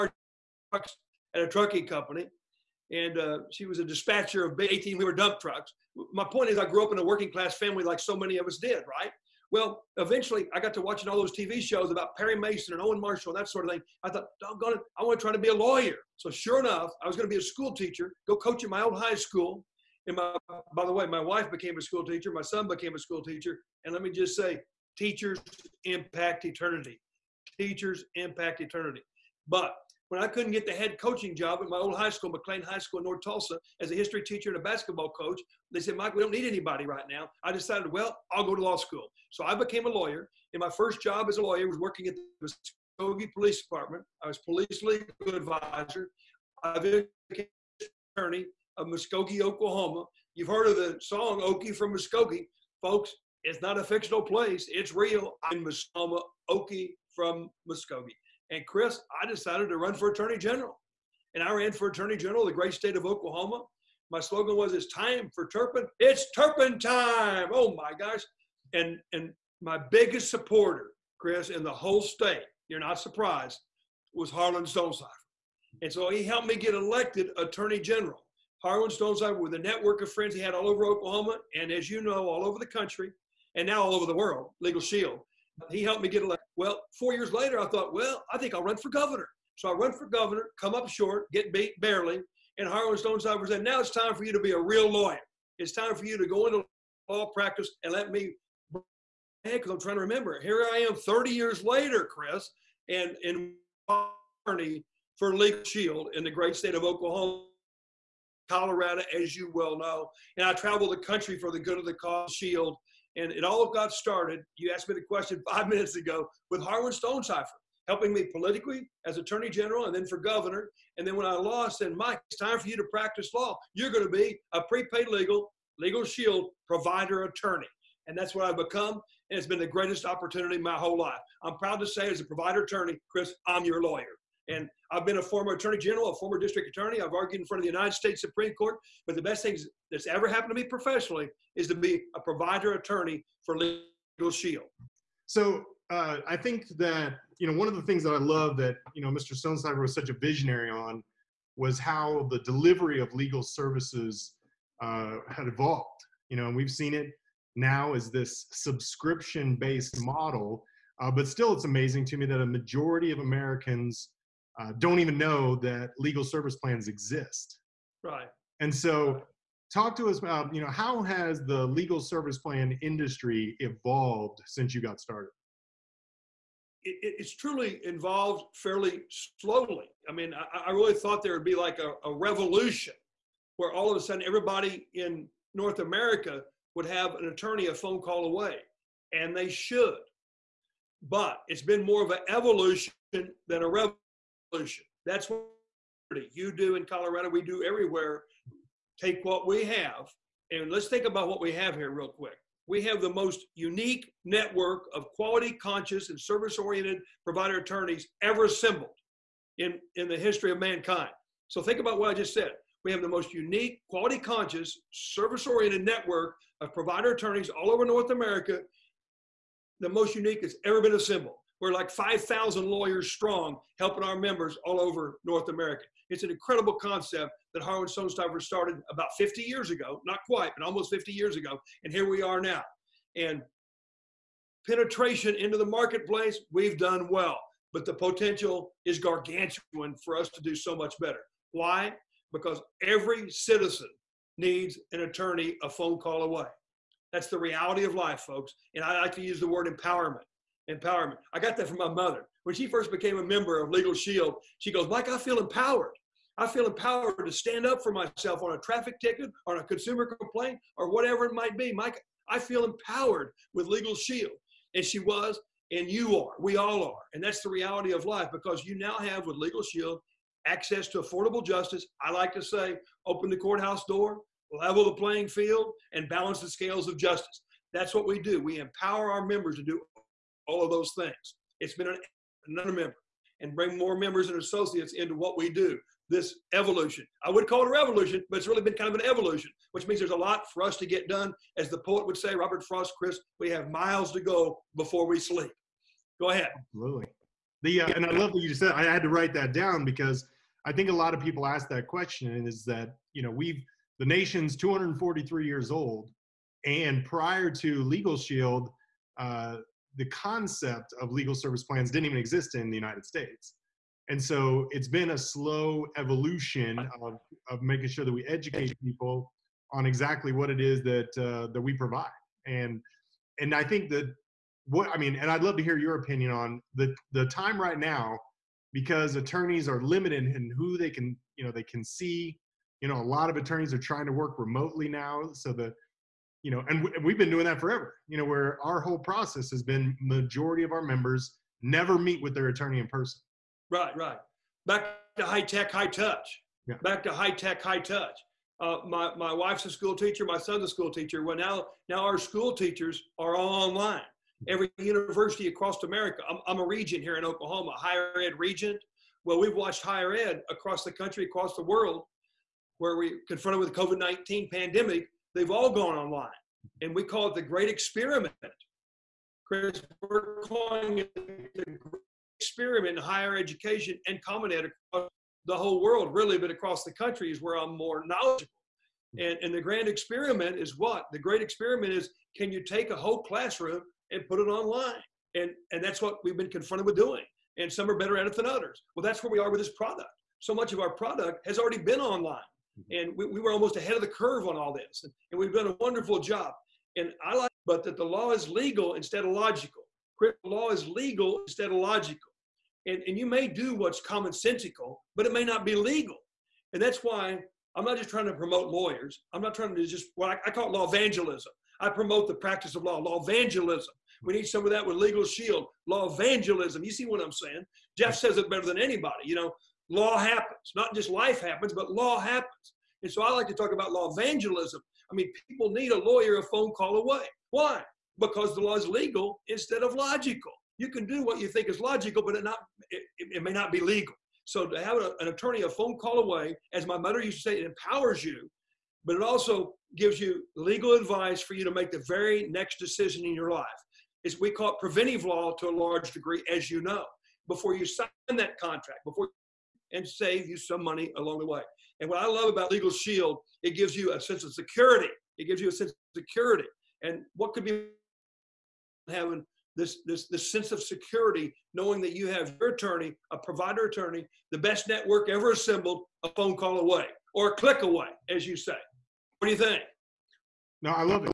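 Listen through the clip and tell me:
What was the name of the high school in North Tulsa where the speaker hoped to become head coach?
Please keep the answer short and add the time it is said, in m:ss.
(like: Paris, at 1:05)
McLain High School, at 0:32.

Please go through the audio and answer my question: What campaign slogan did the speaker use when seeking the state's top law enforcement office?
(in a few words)
It's time for Turpen.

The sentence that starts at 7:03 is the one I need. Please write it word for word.
And so I like to talk about law evangelism.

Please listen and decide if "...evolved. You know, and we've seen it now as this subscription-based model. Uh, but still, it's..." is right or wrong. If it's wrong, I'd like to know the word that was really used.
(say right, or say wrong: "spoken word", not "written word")
right.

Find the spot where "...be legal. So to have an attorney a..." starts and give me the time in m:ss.
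7:13.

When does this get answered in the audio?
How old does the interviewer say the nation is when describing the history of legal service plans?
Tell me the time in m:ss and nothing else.
5:04.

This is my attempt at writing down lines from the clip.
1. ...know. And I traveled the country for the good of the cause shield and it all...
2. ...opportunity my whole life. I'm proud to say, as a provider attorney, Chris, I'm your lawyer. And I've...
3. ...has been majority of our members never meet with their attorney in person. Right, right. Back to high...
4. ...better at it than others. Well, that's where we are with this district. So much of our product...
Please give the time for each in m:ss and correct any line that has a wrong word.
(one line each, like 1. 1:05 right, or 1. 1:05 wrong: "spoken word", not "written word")
1. 1:49 right
2. 2:10 right
3. 5:39 right
4. 6:27 wrong: "product", not "district".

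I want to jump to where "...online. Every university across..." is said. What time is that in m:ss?
5:53.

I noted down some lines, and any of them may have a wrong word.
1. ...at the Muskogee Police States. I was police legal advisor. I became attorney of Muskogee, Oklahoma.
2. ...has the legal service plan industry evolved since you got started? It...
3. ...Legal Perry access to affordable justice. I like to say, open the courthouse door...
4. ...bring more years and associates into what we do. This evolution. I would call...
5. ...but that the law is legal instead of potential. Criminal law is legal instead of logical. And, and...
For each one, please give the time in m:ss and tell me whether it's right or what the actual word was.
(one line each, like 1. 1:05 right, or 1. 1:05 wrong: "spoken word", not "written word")
1. 0:42 wrong: "Department", not "States"
2. 2:51 right
3. 4:29 wrong: "Shield", not "Perry"
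4. 4:43 wrong: "members", not "years"
5. 6:37 wrong: "logical", not "potential".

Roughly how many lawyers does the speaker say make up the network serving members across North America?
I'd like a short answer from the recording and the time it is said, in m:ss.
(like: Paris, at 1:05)
5,000, at 3:41.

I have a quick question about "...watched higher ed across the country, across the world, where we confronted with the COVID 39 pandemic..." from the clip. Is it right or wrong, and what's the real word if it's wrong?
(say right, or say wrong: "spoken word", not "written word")
wrong: "19", not "39".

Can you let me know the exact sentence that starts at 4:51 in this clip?
As the poet would say, Robert Frost, Chris, we have miles to go before we sleep.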